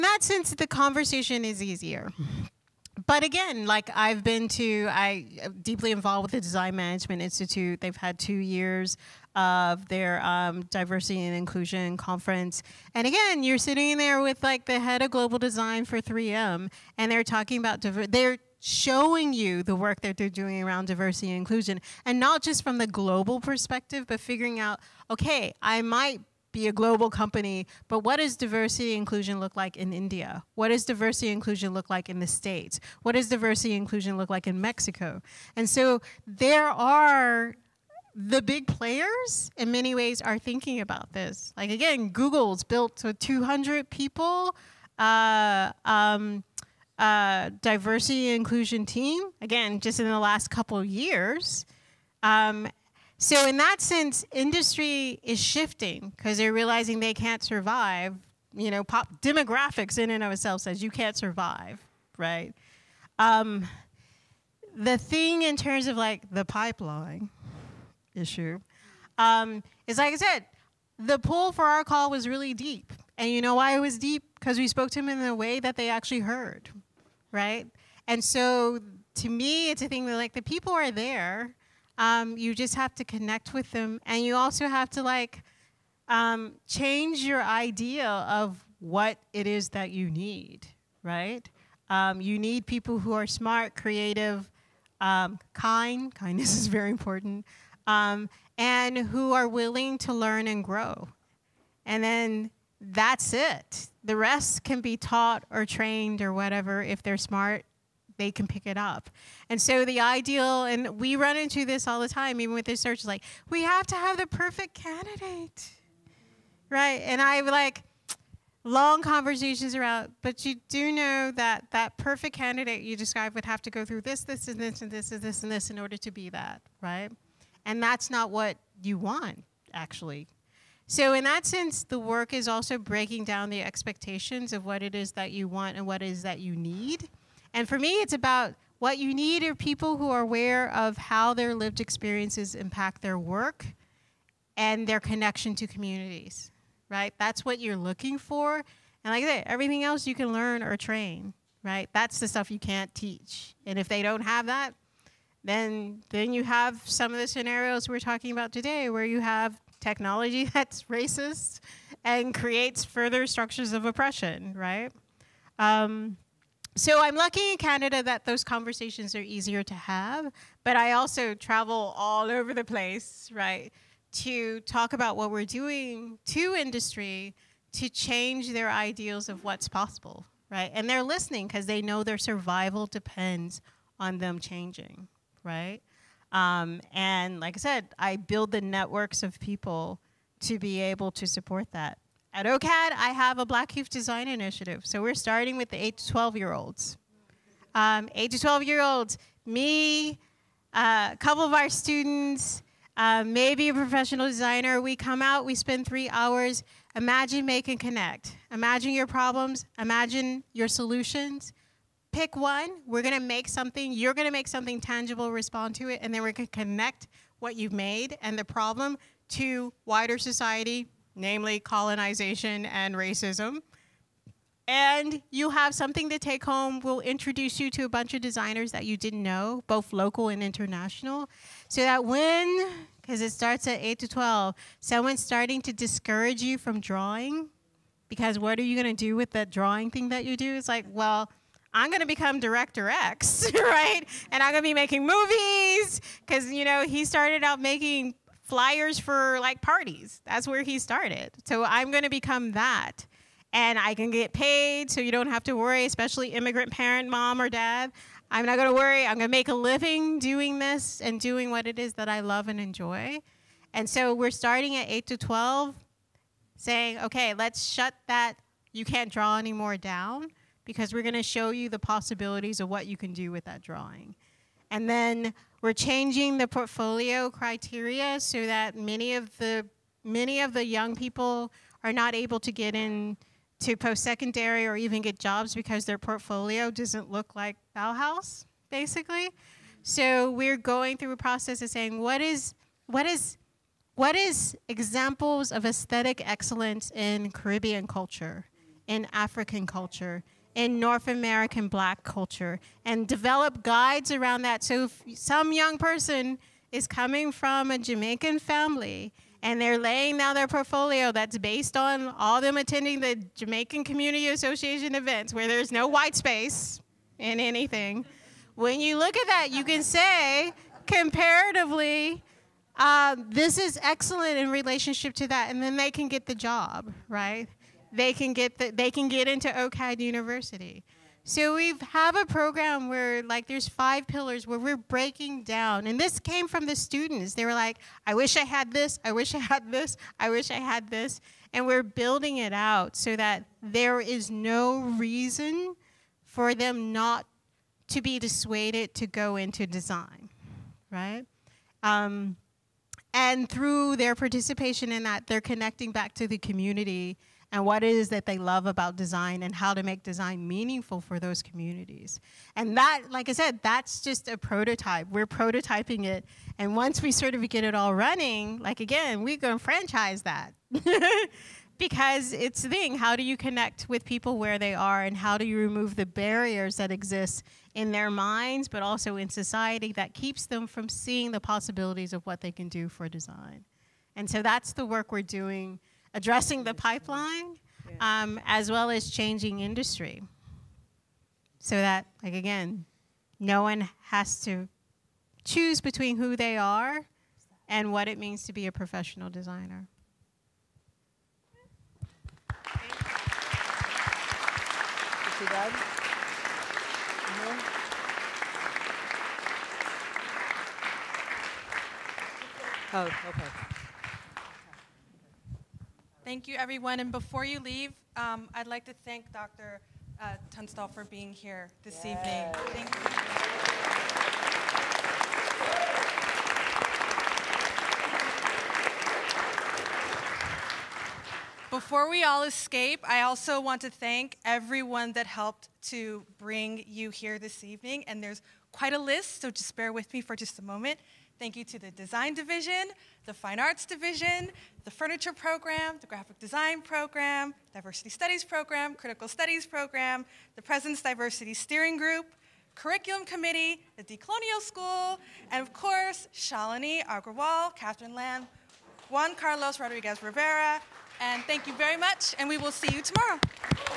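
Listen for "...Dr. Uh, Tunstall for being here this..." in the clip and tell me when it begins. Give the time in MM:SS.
06:59.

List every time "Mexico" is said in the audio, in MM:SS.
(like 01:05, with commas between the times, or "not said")
00:34.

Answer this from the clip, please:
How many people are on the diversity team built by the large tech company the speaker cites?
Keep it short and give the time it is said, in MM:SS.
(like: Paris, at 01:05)
200, at 00:43.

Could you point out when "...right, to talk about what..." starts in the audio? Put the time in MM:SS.
02:53.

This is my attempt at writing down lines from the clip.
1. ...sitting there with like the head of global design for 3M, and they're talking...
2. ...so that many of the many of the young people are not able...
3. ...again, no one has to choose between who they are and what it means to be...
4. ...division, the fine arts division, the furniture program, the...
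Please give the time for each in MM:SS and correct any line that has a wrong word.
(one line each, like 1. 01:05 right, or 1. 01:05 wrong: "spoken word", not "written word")
1. 00:13 right
2. 04:38 right
3. 06:32 right
4. 07:22 right.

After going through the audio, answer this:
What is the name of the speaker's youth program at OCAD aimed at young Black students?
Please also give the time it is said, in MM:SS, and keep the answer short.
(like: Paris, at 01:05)
Black Youth Design Initiative, at 03:13.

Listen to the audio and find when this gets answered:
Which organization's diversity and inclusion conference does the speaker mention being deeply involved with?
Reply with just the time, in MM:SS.
00:06.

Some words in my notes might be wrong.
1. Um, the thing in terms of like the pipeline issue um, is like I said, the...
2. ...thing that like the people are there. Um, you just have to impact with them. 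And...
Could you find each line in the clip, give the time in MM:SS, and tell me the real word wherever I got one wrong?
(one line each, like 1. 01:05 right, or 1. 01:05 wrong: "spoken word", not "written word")
1. 01:03 right
2. 01:19 wrong: "connect", not "impact".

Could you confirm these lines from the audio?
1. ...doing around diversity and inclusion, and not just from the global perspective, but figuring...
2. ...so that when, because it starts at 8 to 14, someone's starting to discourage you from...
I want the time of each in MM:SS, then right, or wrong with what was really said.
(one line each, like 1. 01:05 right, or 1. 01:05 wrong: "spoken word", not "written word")
1. 00:20 right
2. 03:51 wrong: "12", not "14".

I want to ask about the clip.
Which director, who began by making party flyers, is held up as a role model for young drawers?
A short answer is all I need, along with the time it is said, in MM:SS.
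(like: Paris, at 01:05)
Director X, at 04:02.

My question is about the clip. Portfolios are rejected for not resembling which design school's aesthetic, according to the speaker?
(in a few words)
Bauhaus.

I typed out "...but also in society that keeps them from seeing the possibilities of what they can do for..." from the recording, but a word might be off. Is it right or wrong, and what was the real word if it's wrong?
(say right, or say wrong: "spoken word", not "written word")
right.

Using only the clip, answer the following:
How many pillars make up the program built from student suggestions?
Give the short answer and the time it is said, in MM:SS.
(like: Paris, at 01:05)
5, at 05:33.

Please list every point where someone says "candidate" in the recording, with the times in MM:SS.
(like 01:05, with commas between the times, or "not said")
01:54, 02:02.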